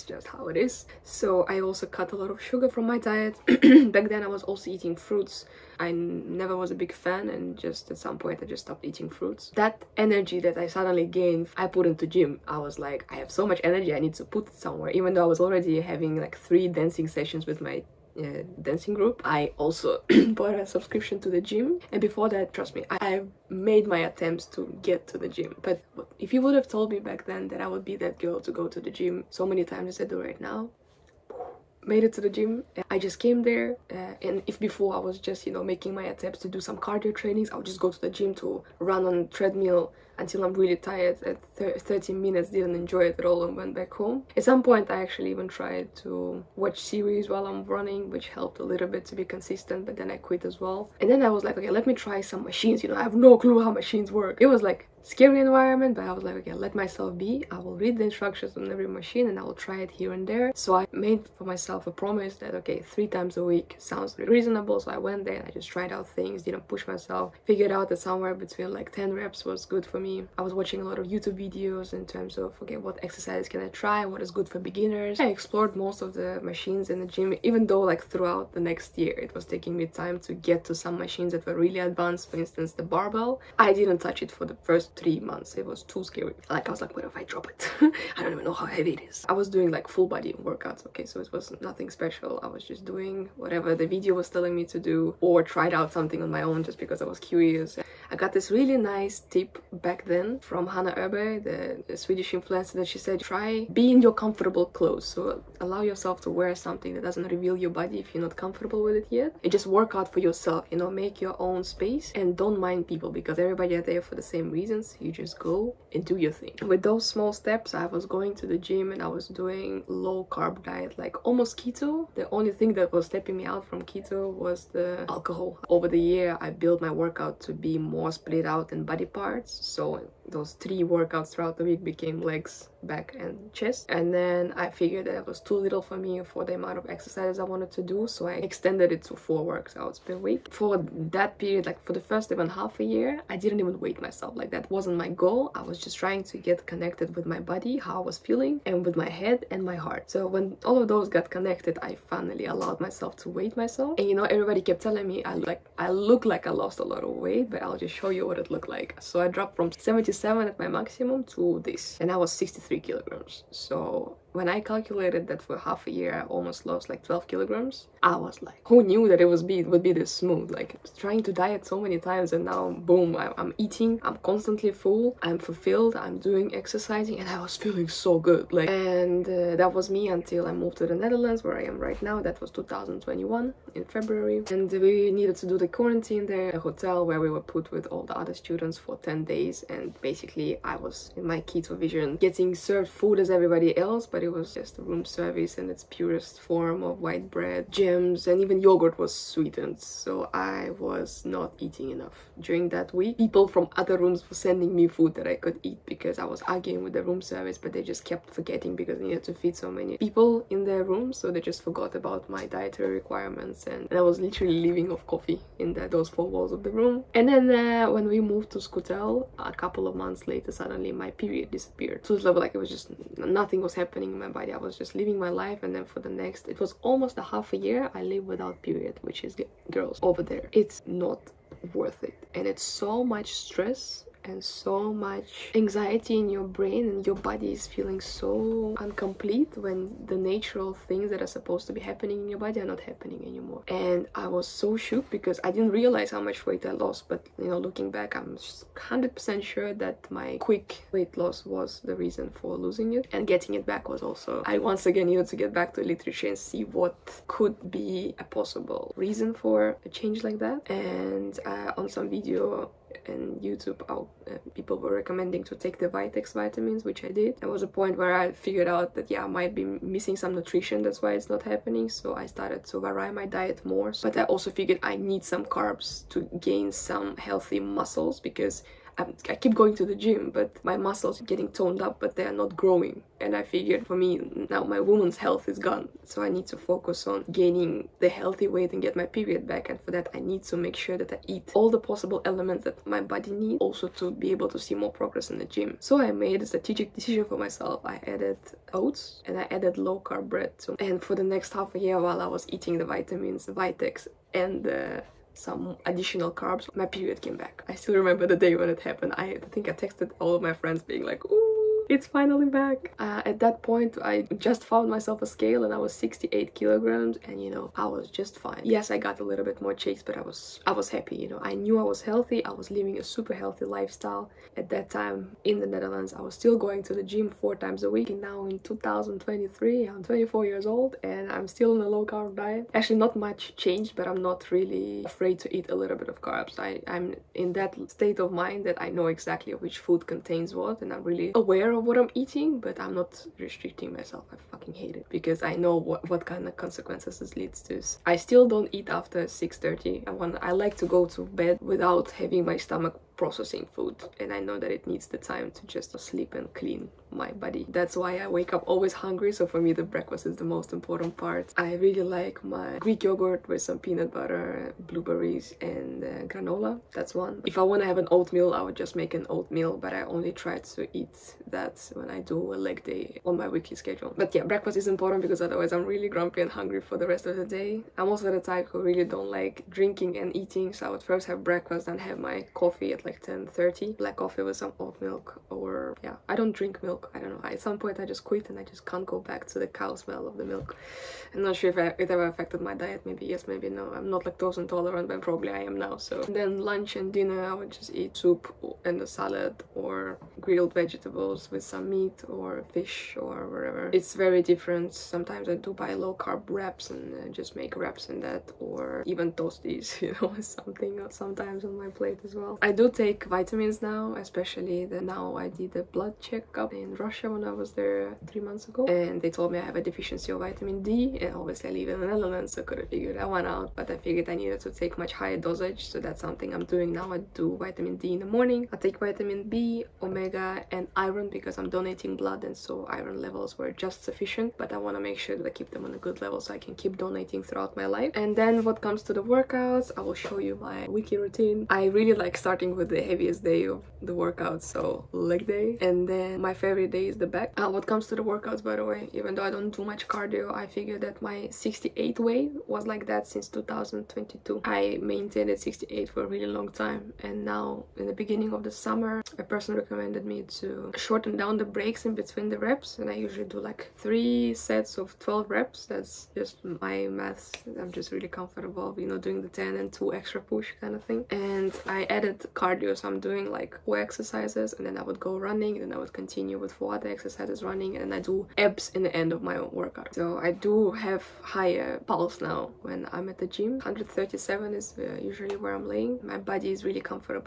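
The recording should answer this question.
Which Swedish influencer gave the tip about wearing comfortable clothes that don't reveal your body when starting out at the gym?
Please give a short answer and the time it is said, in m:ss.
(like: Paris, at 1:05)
Hanna Erbe, at 1:40.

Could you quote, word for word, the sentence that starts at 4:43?
And I figured for me, now my woman's health is gone.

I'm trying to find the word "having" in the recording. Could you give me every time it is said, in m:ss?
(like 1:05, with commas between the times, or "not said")
0:15, 5:52.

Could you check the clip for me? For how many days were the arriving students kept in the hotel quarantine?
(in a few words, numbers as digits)
10 days.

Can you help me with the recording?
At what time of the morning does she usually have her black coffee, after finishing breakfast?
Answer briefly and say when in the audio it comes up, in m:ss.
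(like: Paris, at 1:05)
10:30, at 6:23.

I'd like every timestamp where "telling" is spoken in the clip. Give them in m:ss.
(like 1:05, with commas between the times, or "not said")
1:34, 2:34.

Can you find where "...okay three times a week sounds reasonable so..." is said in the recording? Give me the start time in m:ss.
1:02.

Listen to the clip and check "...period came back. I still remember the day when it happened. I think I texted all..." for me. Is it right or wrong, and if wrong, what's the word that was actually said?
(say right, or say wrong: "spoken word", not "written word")
right.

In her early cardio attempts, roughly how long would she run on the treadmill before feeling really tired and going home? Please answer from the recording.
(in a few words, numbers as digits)
30 minutes.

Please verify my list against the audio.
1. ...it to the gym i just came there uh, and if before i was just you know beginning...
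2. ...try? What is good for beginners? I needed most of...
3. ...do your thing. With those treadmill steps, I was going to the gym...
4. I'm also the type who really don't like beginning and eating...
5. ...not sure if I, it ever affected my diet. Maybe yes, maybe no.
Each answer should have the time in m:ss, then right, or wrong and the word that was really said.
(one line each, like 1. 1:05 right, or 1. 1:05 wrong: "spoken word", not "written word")
1. 0:32 wrong: "making", not "beginning"
2. 1:13 wrong: "explored", not "needed"
3. 1:56 wrong: "small", not "treadmill"
4. 6:17 wrong: "drinking", not "beginning"
5. 6:31 right.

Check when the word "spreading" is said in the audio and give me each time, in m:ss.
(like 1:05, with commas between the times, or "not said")
not said.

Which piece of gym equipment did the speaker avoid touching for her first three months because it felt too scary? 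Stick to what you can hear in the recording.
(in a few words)
The barbell.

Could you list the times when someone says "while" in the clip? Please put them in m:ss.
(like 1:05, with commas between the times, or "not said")
0:47, 5:02.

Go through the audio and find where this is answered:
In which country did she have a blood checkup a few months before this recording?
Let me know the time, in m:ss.
6:56.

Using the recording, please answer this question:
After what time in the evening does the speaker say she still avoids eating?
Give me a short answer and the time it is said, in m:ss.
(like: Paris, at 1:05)
6:30, at 5:49.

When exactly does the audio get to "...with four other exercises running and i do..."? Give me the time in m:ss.
7:56.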